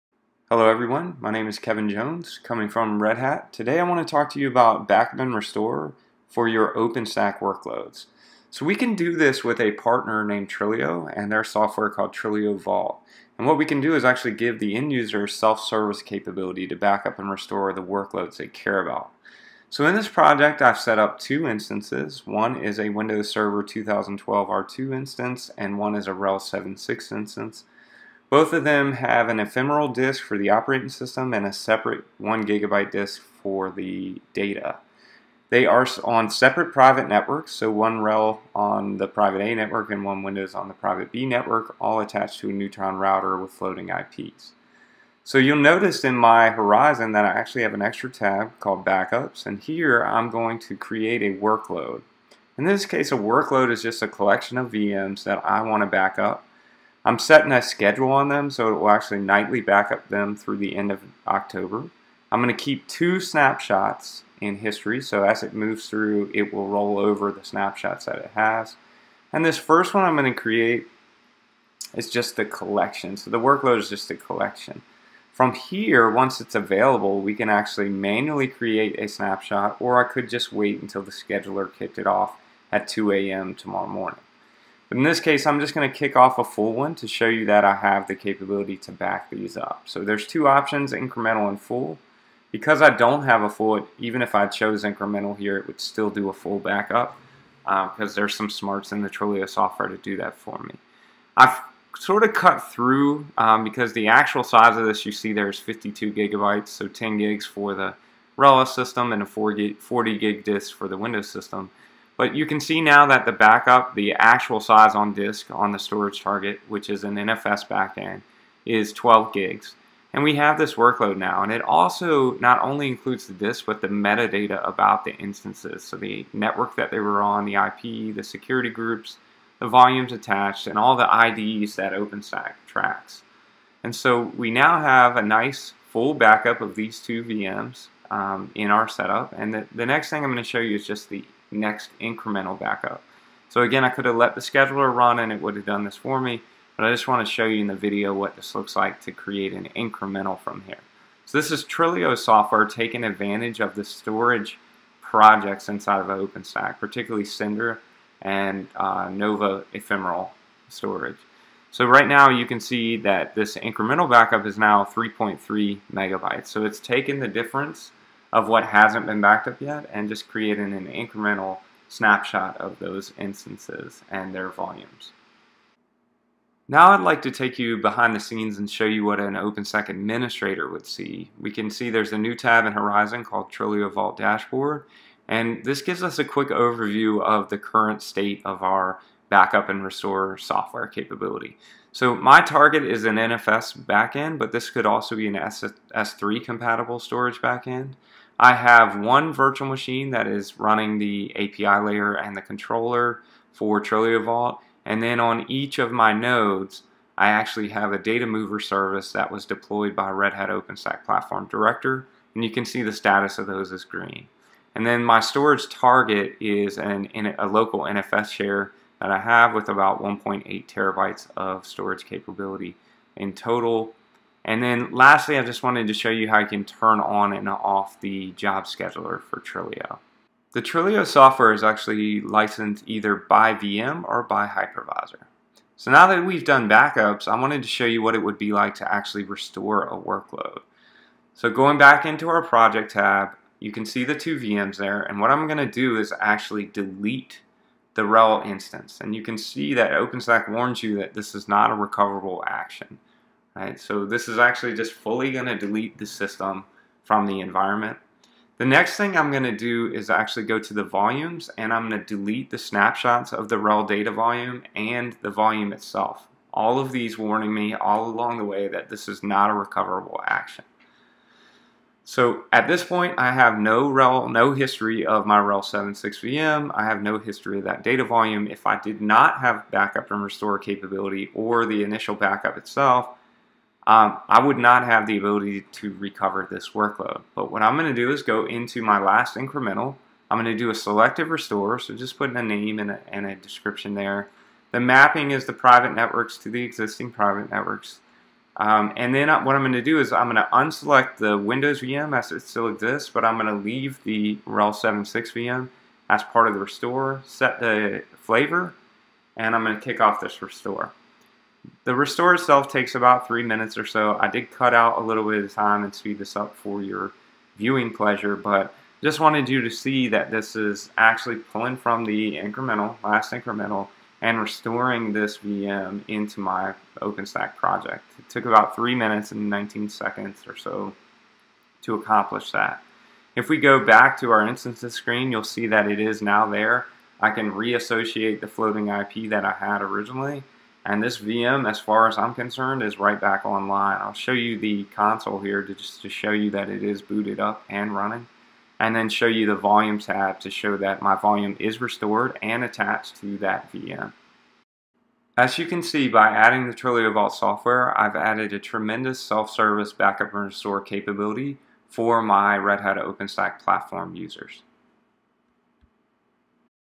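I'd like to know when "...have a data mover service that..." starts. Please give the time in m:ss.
3:27.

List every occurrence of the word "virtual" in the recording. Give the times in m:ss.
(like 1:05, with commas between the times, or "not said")
3:19.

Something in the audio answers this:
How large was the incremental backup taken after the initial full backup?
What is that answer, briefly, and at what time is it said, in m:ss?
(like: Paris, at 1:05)
3.3 megabytes, at 2:44.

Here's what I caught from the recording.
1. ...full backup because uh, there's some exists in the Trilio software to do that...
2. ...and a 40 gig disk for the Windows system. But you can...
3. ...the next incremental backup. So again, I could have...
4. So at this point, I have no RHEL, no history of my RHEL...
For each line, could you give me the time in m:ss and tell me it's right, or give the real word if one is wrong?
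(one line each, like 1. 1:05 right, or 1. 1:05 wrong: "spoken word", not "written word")
1. 1:36 wrong: "smarts", not "exists"
2. 1:49 right
3. 2:21 right
4. 4:32 right.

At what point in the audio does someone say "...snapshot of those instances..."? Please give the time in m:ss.
2:51.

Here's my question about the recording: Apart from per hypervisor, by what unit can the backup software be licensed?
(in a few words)
By VM.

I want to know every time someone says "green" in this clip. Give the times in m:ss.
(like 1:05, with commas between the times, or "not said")
3:33.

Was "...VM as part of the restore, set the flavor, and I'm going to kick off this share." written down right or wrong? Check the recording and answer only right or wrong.
wrong.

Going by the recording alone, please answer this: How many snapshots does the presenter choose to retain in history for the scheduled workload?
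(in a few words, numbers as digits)
2.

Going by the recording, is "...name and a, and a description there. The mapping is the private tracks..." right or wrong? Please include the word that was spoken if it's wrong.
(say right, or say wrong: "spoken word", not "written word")
wrong: "networks", not "tracks".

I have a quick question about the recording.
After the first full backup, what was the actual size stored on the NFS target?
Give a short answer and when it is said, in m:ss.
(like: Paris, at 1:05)
12 gigs, at 1:58.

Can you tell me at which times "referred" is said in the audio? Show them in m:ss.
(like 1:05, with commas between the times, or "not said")
not said.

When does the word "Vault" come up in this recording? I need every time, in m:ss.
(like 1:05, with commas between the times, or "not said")
0:12, 3:03, 3:24, 5:57.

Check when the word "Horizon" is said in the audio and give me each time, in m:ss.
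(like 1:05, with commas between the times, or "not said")
0:46, 3:02.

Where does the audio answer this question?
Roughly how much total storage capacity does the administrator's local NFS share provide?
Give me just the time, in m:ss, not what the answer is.
3:40.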